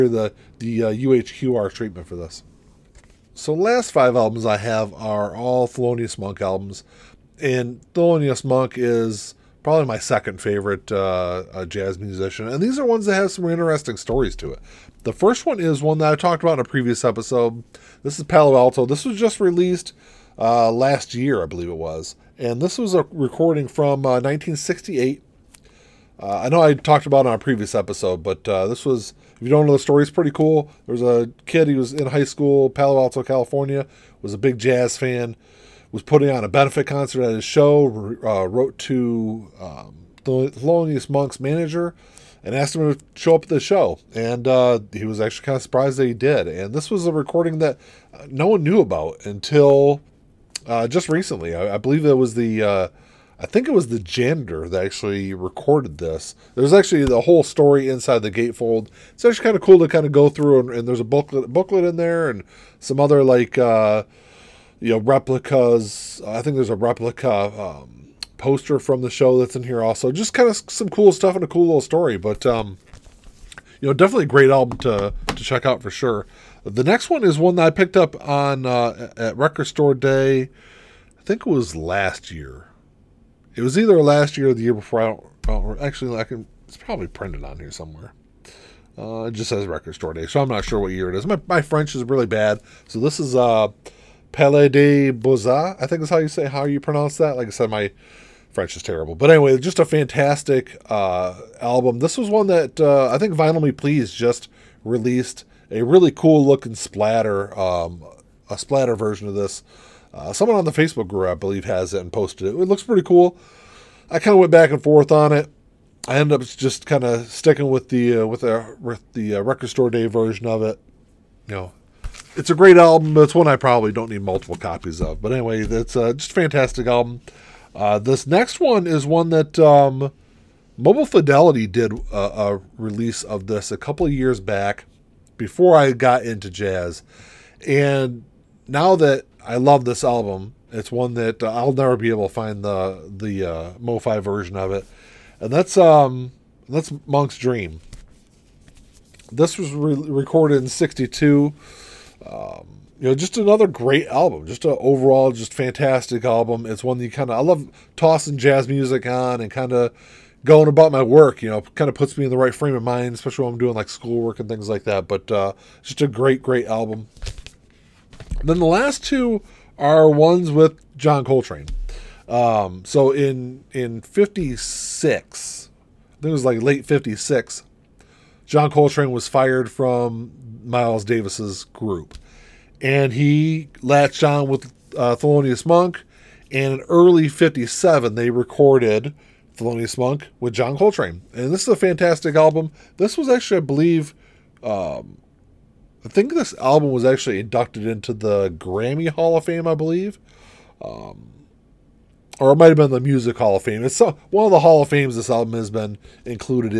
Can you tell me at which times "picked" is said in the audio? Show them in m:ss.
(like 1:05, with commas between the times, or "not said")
1:17.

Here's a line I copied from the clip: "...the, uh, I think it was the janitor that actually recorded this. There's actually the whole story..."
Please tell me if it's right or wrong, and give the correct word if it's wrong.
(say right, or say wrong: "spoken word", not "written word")
right.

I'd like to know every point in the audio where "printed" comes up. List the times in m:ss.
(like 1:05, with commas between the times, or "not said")
1:27.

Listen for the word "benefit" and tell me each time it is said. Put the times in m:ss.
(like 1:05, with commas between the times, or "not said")
0:36.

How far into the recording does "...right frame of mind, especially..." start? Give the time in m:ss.
2:42.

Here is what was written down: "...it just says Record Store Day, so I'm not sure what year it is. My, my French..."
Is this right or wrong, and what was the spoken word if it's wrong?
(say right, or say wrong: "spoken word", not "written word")
right.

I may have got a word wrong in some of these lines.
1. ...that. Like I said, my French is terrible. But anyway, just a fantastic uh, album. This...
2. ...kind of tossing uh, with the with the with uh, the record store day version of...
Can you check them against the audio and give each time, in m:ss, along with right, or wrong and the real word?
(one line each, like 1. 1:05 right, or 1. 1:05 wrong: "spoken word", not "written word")
1. 1:37 right
2. 1:56 wrong: "sticking", not "tossing".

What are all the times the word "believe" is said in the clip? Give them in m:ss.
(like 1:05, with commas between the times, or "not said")
0:21, 0:51, 1:51, 3:13, 3:19.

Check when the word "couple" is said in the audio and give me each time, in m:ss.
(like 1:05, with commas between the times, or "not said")
2:13.